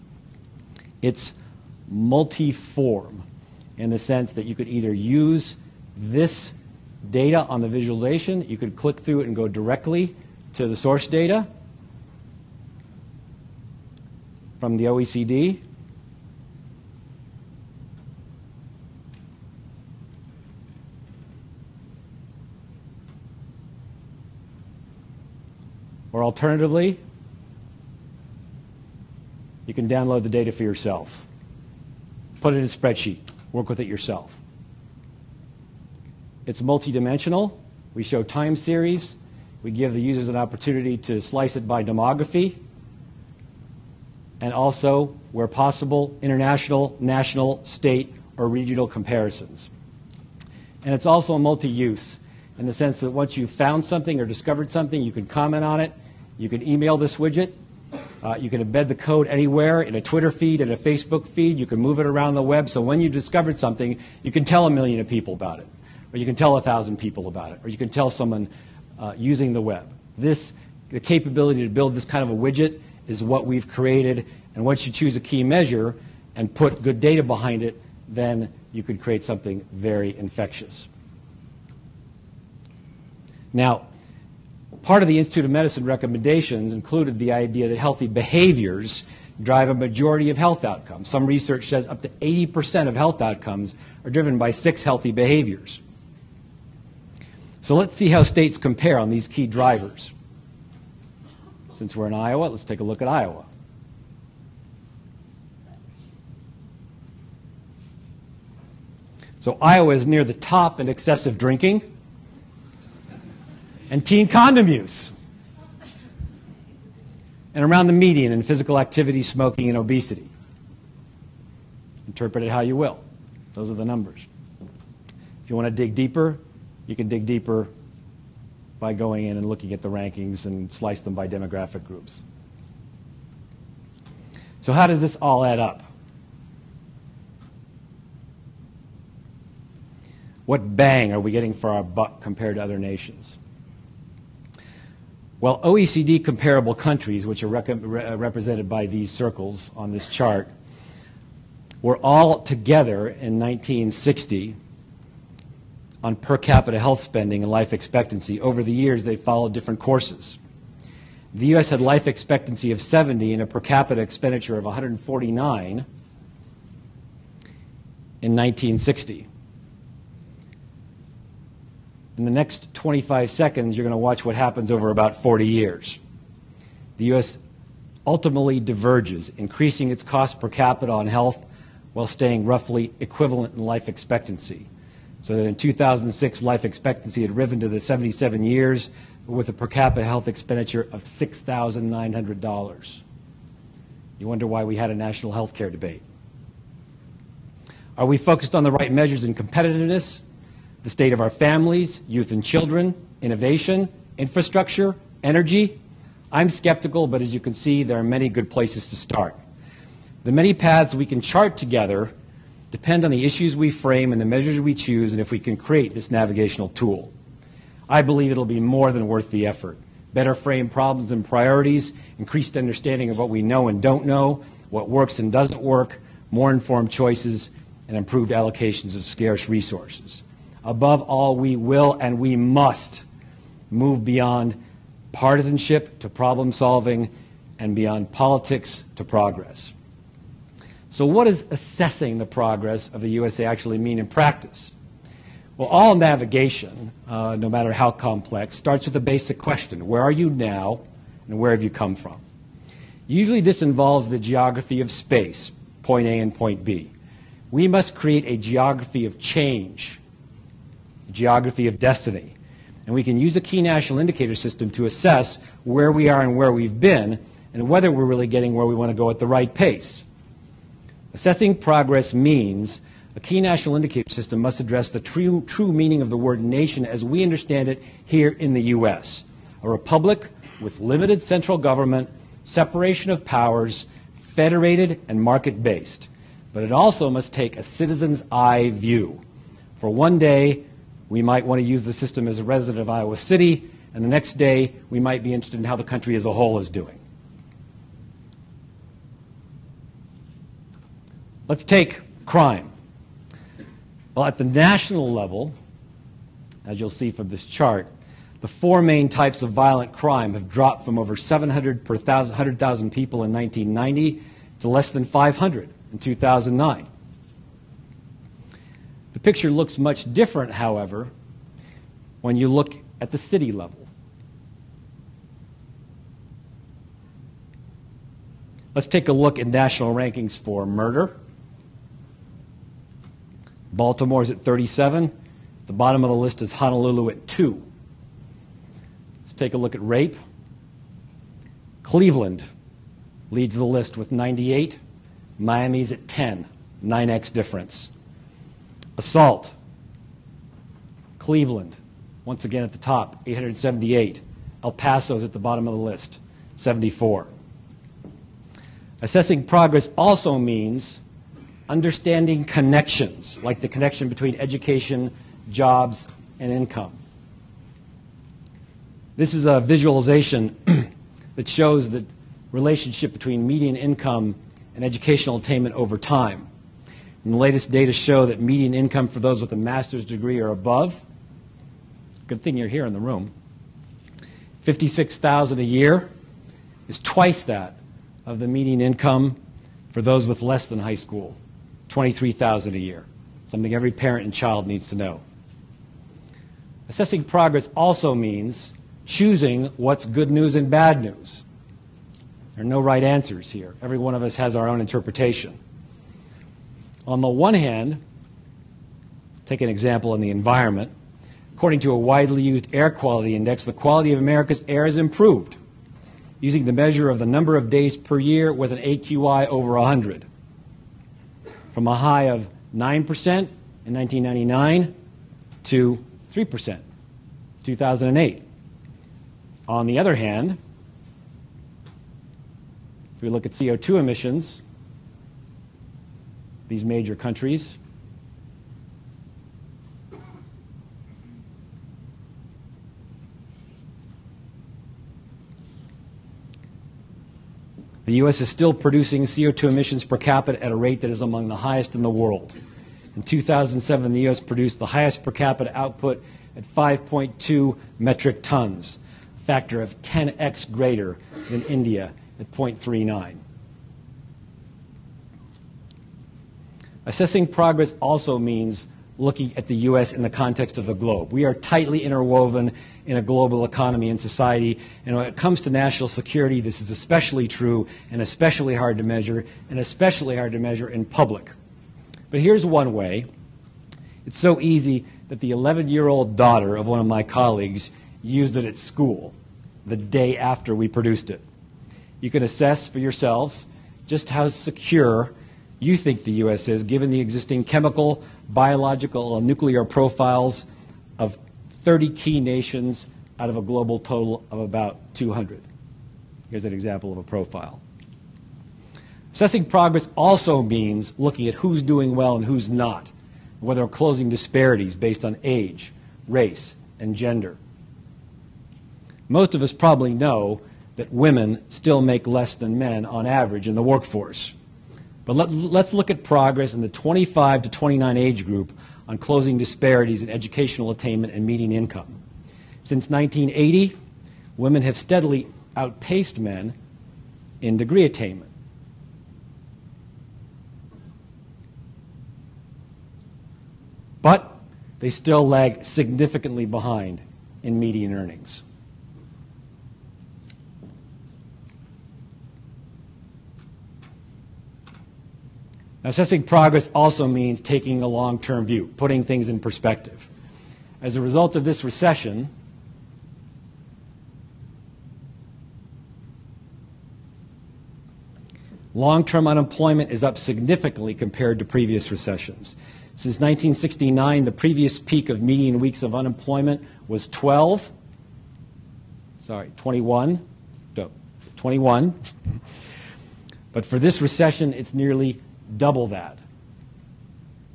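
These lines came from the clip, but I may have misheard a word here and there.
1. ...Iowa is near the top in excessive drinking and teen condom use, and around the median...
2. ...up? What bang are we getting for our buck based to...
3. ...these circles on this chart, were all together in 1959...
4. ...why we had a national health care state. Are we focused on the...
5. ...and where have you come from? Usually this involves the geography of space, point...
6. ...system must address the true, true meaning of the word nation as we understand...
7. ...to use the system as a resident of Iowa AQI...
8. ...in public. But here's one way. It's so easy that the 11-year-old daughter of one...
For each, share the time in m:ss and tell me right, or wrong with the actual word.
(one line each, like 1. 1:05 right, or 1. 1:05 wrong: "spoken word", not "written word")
1. 1:49 right
2. 2:15 wrong: "compared", not "based"
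3. 2:28 wrong: "1960", not "1959"
4. 3:14 wrong: "debate", not "state"
5. 4:11 right
6. 4:34 right
7. 4:51 wrong: "City", not "AQI"
8. 8:00 right.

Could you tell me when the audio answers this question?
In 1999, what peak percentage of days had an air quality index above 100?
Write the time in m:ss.
7:02.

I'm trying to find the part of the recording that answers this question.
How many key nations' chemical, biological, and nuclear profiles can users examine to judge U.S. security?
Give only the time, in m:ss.
8:21.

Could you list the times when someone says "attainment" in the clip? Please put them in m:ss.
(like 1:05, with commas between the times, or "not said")
6:15, 8:50, 8:58.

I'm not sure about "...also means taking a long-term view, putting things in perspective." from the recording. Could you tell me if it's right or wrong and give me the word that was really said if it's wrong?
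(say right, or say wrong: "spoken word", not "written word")
right.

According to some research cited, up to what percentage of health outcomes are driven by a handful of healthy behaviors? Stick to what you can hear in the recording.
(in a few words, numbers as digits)
80%.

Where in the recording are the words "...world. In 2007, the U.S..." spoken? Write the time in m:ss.
7:32.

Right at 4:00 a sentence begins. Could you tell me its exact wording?
So what does assessing the progress of the USA actually mean in practice?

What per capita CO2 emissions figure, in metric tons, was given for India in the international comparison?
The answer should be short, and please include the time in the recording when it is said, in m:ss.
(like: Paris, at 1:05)
0.39, at 7:42.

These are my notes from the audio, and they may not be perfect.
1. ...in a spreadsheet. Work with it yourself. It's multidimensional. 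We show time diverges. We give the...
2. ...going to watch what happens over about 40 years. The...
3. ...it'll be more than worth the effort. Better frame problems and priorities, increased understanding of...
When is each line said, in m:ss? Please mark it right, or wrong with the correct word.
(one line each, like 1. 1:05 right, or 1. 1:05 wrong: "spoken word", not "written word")
1. 0:32 wrong: "series", not "diverges"
2. 2:53 right
3. 3:38 right.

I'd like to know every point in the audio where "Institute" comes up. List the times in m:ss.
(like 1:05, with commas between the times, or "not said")
1:25.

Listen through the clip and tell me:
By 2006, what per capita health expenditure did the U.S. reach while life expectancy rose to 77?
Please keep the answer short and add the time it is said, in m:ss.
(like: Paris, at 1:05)
$6,900, at 3:11.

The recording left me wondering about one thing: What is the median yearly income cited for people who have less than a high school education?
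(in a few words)
23,000.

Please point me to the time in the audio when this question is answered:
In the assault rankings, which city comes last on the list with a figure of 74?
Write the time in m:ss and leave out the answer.
5:54.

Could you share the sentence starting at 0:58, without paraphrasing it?
Uh, you can embed the code anywhere in a Twitter feed, in a Facebook feed.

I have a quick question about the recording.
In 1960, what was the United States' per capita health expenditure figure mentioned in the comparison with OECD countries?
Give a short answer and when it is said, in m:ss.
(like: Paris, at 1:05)
149, at 2:44.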